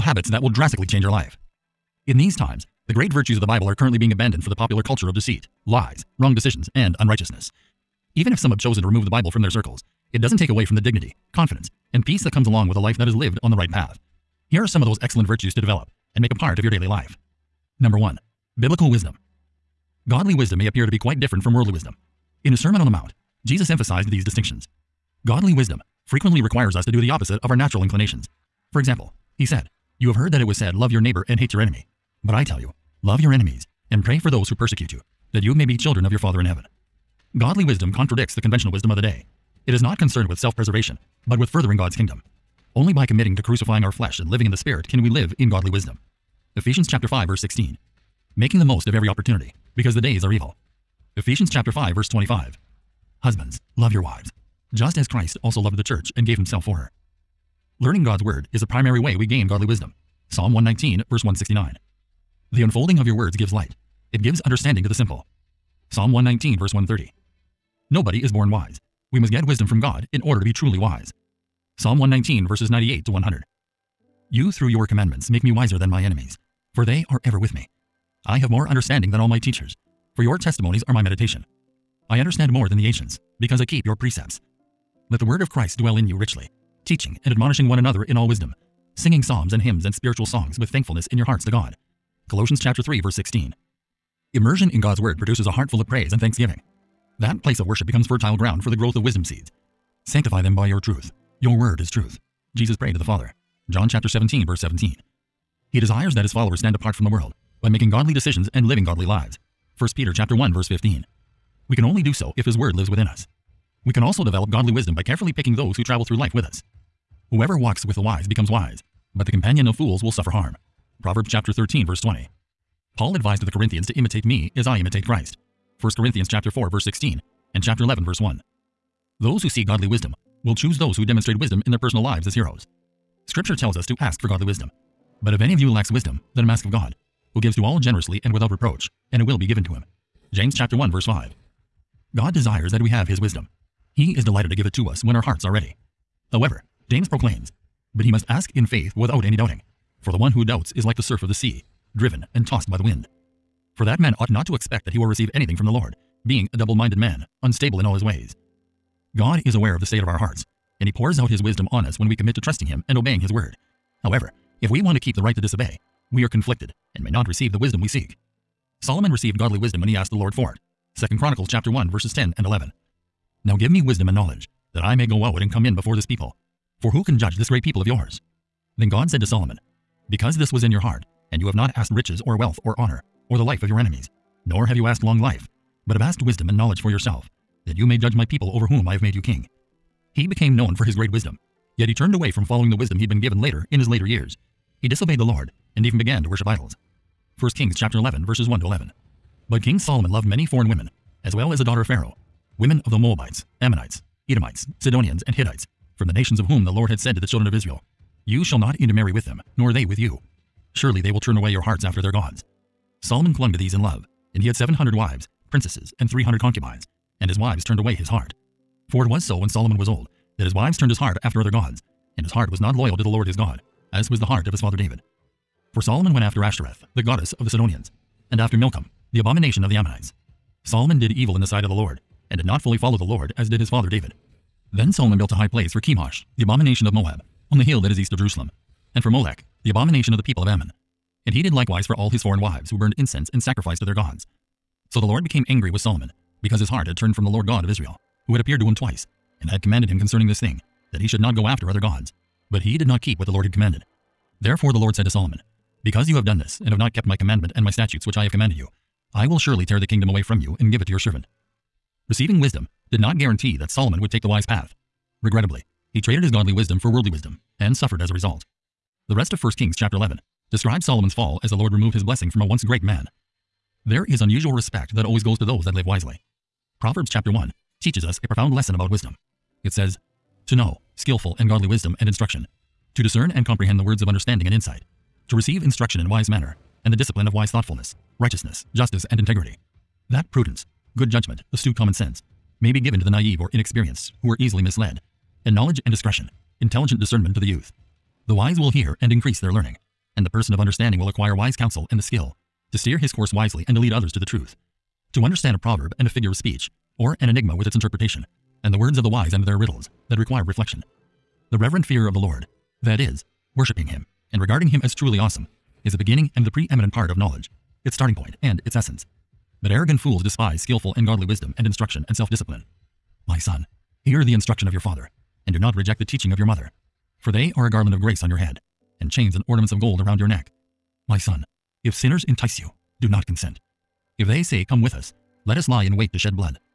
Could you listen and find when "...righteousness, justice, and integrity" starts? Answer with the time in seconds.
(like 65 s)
288 s.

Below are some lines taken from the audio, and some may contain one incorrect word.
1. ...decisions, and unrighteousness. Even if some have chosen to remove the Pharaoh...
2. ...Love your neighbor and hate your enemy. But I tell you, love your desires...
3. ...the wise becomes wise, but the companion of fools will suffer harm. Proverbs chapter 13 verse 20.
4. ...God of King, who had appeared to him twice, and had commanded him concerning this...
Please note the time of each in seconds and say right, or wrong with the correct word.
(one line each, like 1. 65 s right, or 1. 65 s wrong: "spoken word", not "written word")
1. 6 s wrong: "Bible", not "Pharaoh"
2. 30 s wrong: "enemies", not "desires"
3. 117 s right
4. 247 s wrong: "Israel", not "King".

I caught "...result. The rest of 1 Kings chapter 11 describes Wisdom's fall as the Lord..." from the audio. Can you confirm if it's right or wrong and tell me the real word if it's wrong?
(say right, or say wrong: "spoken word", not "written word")
wrong: "Solomon", not "Wisdom".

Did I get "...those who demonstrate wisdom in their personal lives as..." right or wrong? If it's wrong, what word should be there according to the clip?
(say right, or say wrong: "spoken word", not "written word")
right.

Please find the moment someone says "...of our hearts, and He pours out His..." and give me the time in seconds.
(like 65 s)
160 s.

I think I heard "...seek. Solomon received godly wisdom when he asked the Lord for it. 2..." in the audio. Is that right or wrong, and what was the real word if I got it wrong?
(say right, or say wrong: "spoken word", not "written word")
right.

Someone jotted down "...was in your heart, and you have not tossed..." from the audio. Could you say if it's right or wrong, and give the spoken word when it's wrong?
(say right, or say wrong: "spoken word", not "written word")
wrong: "asked", not "tossed".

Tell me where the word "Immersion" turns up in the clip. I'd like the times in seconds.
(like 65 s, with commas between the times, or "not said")
94 s.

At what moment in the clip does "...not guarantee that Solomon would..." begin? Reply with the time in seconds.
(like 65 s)
262 s.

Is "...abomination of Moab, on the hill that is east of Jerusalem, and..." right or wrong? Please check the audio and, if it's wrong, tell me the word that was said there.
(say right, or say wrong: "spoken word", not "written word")
right.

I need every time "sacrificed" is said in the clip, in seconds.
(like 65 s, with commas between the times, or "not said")
243 s.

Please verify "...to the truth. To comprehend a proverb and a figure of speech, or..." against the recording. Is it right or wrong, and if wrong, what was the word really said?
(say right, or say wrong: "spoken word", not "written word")
wrong: "understand", not "comprehend".